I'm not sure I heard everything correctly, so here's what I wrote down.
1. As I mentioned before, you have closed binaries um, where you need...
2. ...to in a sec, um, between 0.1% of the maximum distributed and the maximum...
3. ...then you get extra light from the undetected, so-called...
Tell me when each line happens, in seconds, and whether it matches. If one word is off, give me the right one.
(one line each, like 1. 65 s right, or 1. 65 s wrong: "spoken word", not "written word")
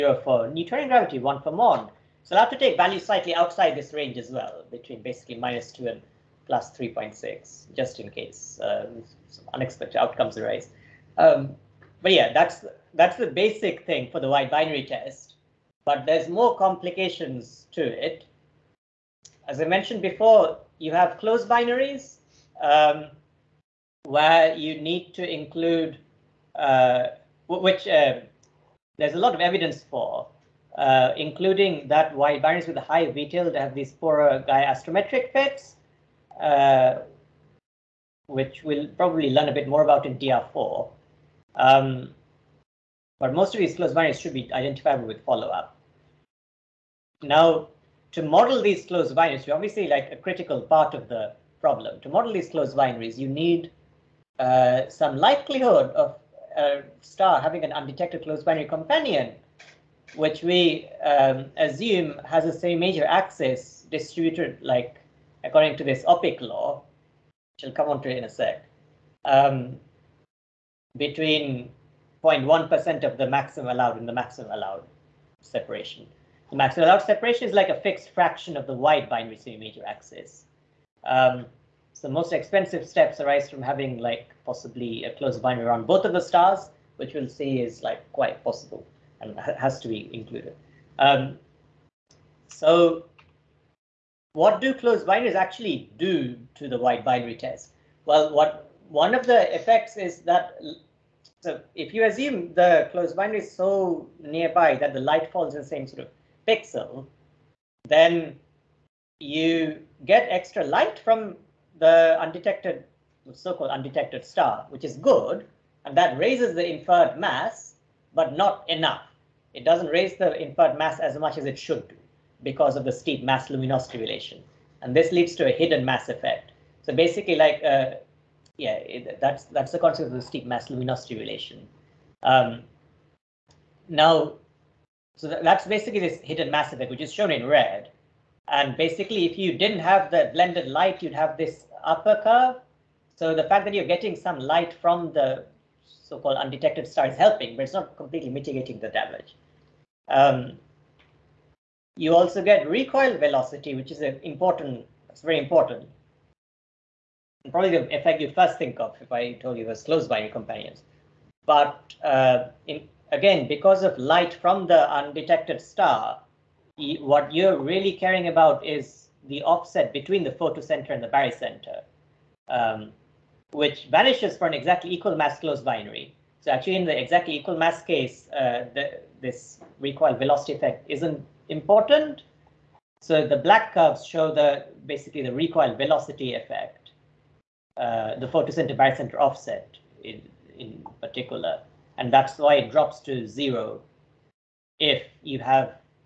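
1. 19 s right
2. 68 s wrong: "allowed", not "distributed"
3. 107 s right.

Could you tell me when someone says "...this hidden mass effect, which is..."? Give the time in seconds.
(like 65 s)
135 s.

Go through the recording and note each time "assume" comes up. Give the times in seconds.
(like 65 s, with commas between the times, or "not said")
61 s, 102 s.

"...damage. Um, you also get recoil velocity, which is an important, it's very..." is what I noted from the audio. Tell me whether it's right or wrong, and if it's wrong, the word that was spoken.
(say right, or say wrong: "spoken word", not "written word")
right.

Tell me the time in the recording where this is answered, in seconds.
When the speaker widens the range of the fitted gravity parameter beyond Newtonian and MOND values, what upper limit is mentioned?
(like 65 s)
6 s.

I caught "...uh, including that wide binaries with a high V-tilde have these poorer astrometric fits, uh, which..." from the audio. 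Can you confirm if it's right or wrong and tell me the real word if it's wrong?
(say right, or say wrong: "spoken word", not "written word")
right.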